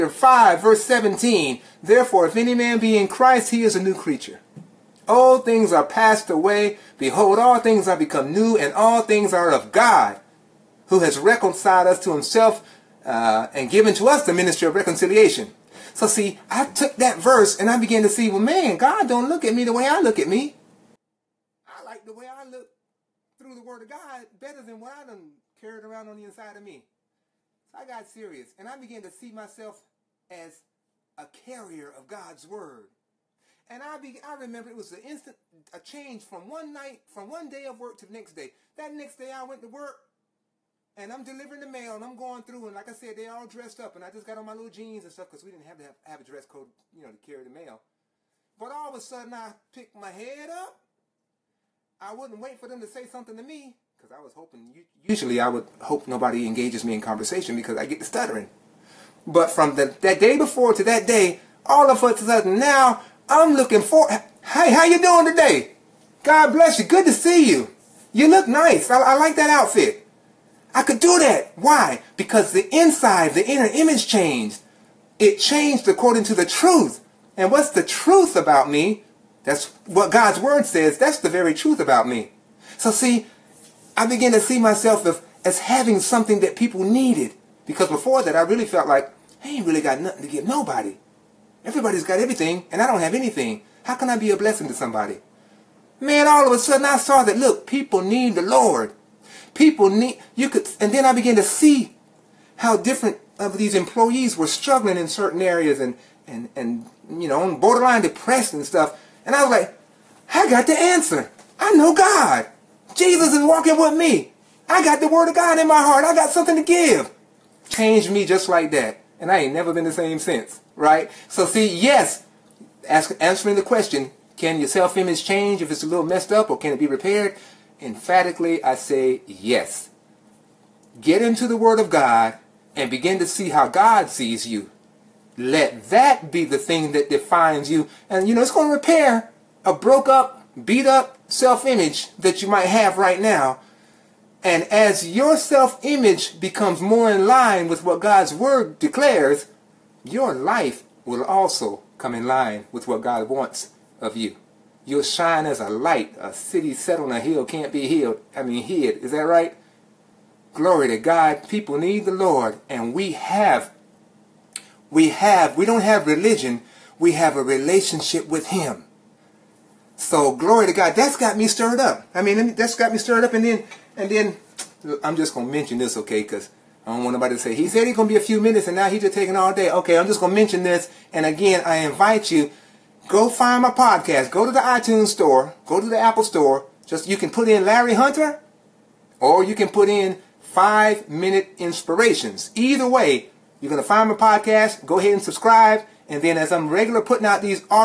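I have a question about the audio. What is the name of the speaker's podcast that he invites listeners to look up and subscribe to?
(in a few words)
Five Minute Inspirationz.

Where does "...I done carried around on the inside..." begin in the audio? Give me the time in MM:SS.
00:24.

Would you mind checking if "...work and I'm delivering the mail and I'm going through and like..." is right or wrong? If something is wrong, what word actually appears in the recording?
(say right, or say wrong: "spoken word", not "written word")
right.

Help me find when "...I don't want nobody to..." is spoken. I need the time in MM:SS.
02:56.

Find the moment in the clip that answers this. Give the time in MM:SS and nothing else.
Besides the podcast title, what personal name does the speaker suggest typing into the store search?
03:07.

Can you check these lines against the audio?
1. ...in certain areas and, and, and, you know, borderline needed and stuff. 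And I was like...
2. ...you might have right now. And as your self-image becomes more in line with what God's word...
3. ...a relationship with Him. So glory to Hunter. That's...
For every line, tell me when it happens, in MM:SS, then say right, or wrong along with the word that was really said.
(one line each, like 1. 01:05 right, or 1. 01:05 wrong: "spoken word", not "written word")
1. 01:44 wrong: "depressed", not "needed"
2. 02:22 right
3. 02:47 wrong: "God", not "Hunter".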